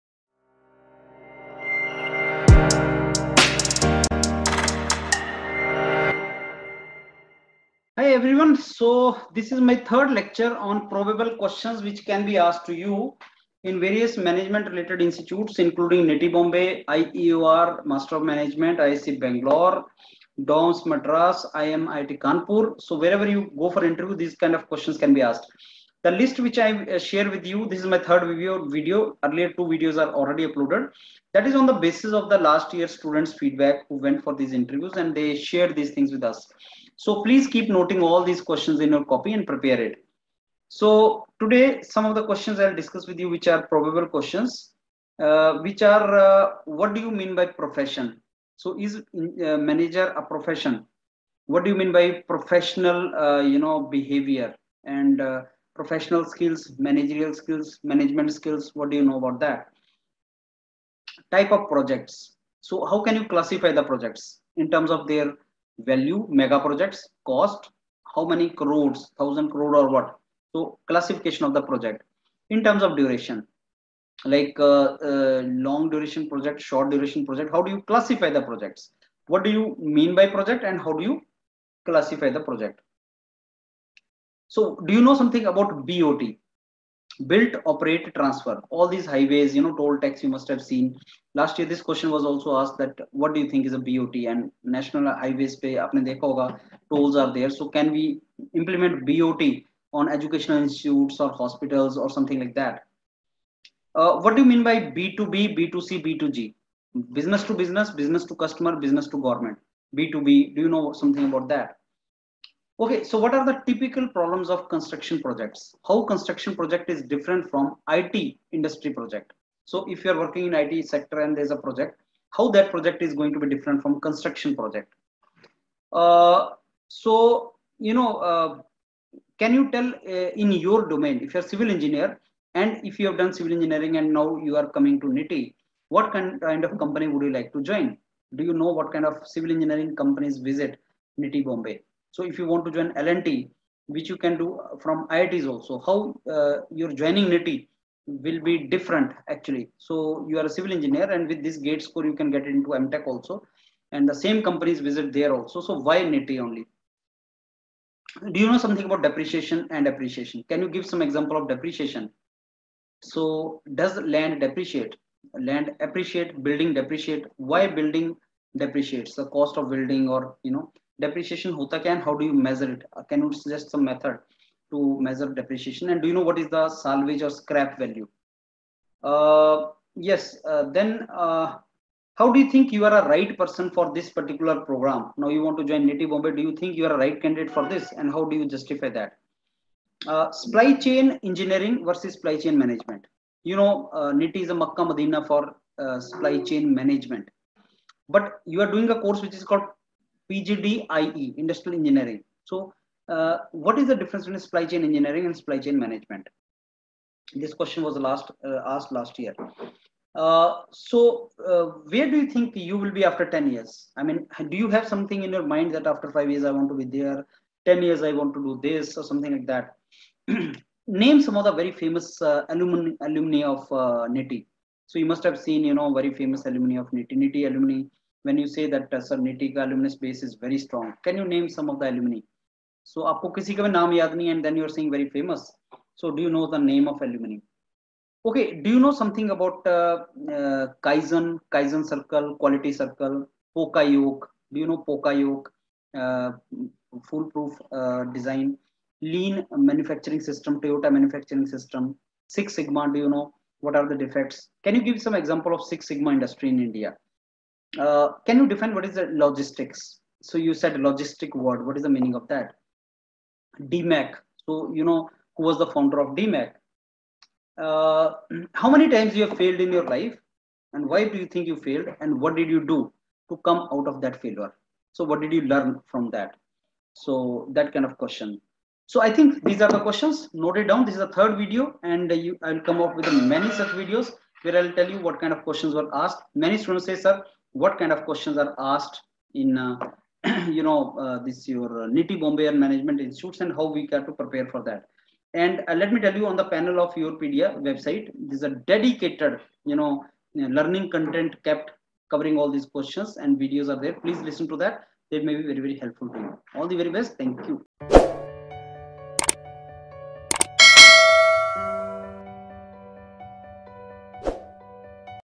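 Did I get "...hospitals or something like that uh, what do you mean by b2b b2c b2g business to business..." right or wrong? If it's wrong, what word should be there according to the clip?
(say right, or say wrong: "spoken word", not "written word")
right.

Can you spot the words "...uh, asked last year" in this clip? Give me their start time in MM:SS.
03:28.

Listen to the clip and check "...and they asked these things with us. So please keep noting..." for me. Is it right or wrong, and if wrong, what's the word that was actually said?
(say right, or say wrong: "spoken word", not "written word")
wrong: "shared", not "asked".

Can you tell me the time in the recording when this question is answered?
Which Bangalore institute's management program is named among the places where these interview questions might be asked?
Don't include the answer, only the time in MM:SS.
00:18.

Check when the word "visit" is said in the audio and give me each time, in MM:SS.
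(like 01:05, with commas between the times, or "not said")
02:20, 02:34.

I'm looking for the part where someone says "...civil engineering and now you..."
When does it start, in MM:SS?
02:13.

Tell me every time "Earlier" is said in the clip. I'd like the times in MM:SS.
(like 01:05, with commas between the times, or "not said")
00:29.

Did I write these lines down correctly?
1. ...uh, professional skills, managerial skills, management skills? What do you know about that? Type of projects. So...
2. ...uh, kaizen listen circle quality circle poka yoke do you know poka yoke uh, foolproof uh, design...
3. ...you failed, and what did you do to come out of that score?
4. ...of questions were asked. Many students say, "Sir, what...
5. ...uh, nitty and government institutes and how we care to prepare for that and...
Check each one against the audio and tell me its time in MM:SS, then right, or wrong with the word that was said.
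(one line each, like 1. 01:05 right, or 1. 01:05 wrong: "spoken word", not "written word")
1. 00:55 right
2. 04:00 wrong: "kaizen", not "listen"
3. 04:31 wrong: "failure", not "score"
4. 04:45 right
5. 04:51 wrong: "management", not "government".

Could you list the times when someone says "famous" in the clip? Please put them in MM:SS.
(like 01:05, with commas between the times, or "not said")
03:41, 03:46, 03:55.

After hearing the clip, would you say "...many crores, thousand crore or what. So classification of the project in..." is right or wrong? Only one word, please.
right.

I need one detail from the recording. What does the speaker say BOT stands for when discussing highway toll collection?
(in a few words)
Built operate transfer.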